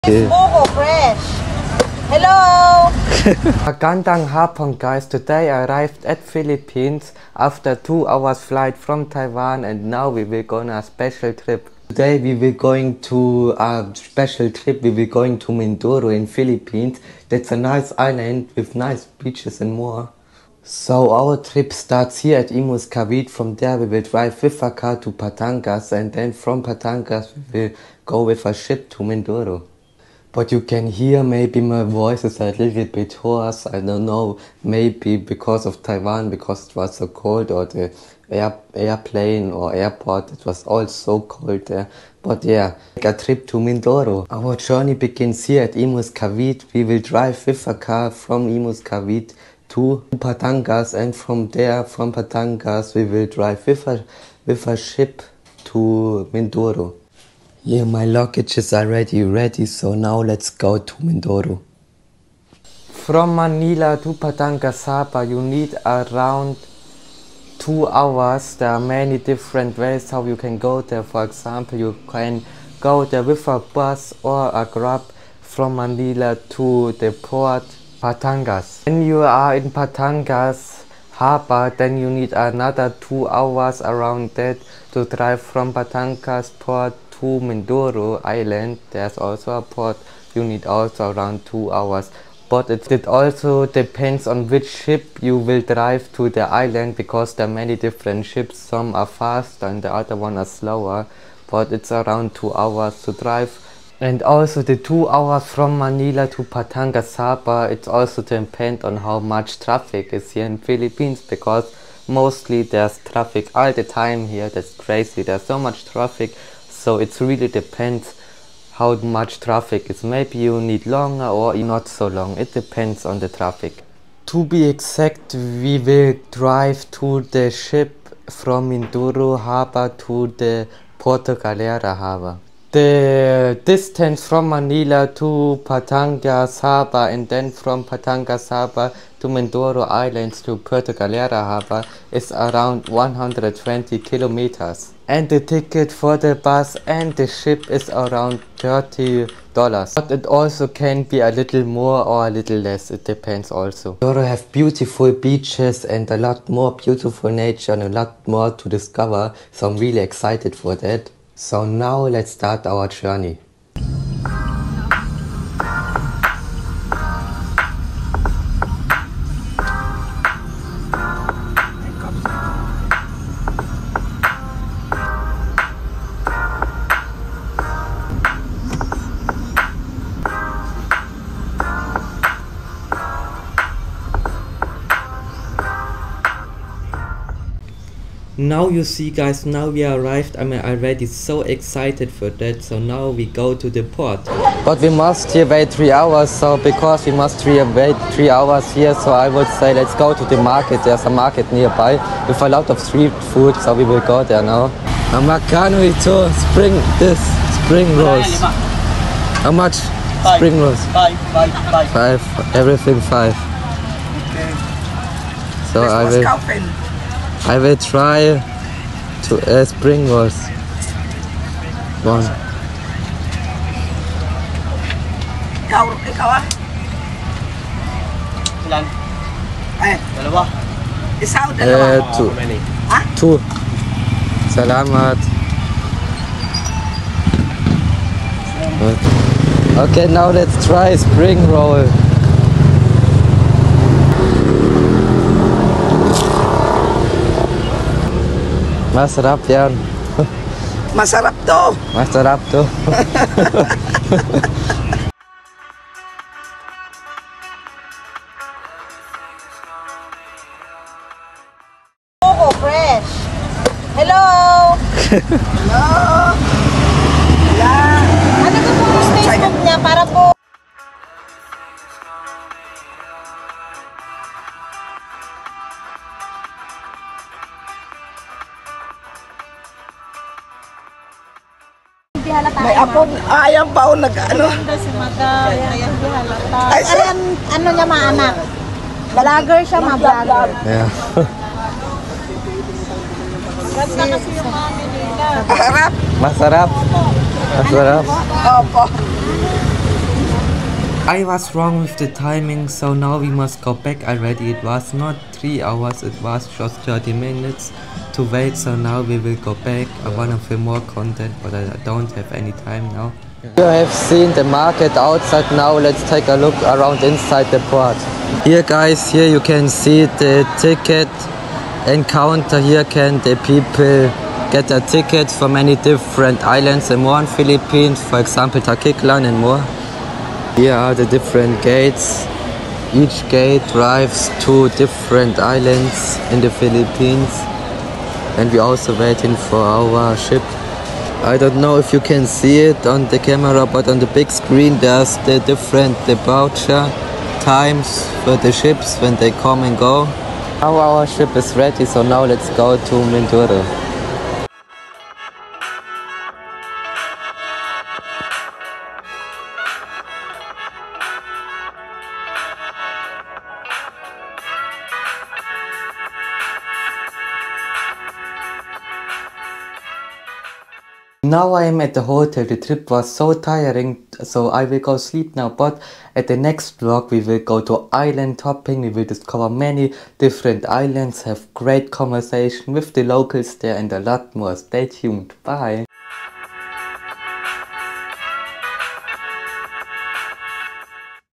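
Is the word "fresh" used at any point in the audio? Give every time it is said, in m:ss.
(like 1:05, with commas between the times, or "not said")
0:00, 4:22.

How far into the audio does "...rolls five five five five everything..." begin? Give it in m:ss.
3:30.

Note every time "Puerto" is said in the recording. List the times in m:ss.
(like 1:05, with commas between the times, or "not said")
2:10, 2:20.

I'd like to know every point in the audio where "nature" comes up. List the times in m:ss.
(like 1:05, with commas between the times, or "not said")
2:37.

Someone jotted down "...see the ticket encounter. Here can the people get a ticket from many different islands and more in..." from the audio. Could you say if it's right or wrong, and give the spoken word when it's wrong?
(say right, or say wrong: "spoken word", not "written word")
right.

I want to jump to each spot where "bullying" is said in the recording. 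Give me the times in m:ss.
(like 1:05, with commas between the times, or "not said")
not said.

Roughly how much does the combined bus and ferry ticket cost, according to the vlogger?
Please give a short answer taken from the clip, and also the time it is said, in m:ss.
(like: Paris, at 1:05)
30 dollars, at 2:28.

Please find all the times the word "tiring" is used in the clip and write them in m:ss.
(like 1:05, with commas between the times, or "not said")
6:13.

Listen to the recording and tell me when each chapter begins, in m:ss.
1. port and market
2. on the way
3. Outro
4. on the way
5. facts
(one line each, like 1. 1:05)
1. 3:22
2. 5:55
3. 6:16
4. 2:44
5. 0:26.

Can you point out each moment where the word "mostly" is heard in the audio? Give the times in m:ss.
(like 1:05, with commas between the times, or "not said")
1:52.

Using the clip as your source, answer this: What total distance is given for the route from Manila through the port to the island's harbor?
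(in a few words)
120 kilometers.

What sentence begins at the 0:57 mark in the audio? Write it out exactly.
Yeah, my luggage is already ready, so now let's go to Mindoro.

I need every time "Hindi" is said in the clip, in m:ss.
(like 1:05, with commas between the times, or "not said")
4:42.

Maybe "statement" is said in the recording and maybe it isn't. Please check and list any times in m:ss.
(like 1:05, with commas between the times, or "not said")
not said.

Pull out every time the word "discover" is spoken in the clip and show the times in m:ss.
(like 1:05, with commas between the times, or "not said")
2:38, 6:19.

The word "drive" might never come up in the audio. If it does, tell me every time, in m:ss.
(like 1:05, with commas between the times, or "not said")
0:24, 0:47, 0:53, 1:25, 1:35, 1:43, 2:06, 5:33.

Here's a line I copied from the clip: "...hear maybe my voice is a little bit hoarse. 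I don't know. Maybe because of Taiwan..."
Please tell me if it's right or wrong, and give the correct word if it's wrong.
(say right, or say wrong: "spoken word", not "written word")
right.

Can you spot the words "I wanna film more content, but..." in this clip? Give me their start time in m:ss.
5:10.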